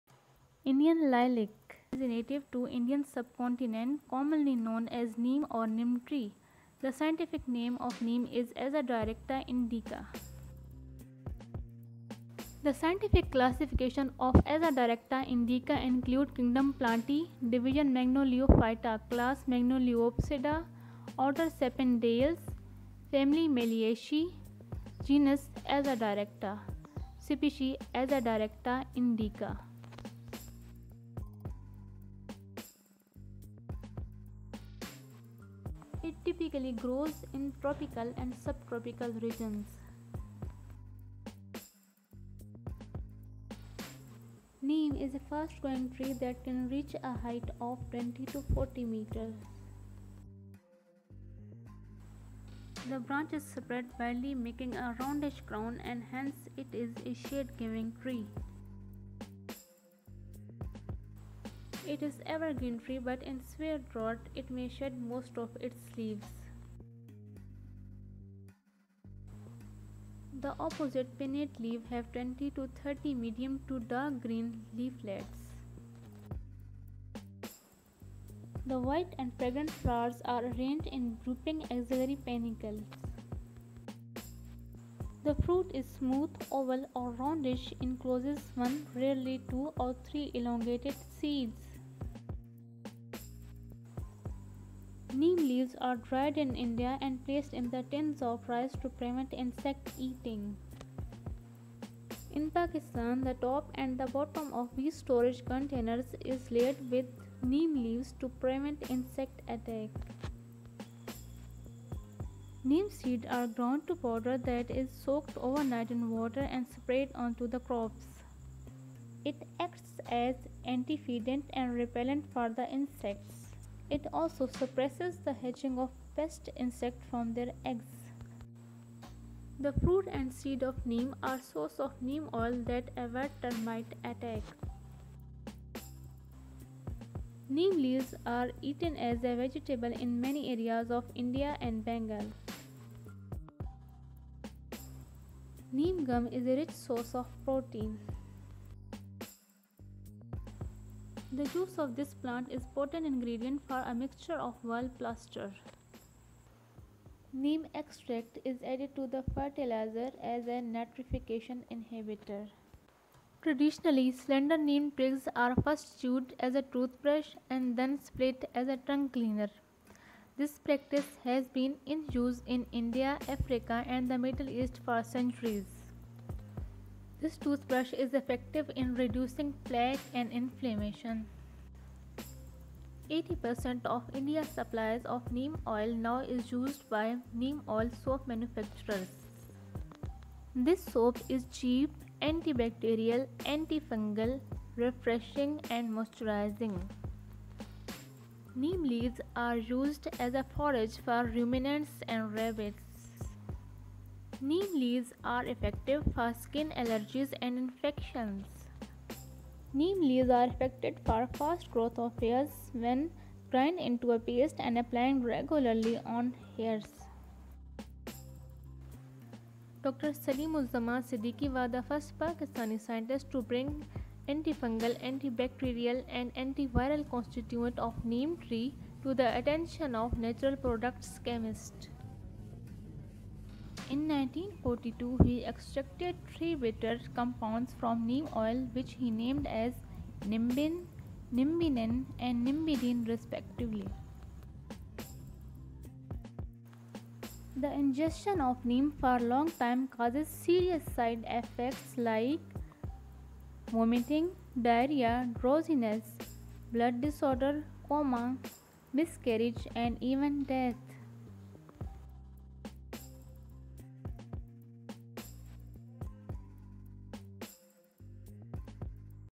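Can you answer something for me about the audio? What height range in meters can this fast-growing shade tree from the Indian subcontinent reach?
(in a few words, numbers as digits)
20 to 40 meters.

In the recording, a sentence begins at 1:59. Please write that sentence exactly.
It acts as antifeedant and repellent for the insects.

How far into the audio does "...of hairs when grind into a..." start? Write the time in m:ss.
3:31.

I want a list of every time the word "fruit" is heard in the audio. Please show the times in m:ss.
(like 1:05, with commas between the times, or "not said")
1:25, 2:09.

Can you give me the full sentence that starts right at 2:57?
This toothbrush is effective in reducing plaque and inflammation.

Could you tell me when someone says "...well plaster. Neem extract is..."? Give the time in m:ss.
2:34.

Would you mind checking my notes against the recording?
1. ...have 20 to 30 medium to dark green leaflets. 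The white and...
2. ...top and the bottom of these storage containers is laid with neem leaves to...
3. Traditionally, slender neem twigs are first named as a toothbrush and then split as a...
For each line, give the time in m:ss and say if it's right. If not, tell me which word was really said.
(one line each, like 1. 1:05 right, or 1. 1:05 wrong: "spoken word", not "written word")
1. 1:11 right
2. 1:43 right
3. 2:43 wrong: "chewed", not "named".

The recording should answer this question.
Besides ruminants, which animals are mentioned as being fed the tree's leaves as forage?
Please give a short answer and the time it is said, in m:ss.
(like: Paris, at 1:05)
Rabbits, at 3:22.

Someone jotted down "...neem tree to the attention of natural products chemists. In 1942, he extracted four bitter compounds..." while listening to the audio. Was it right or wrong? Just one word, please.
wrong.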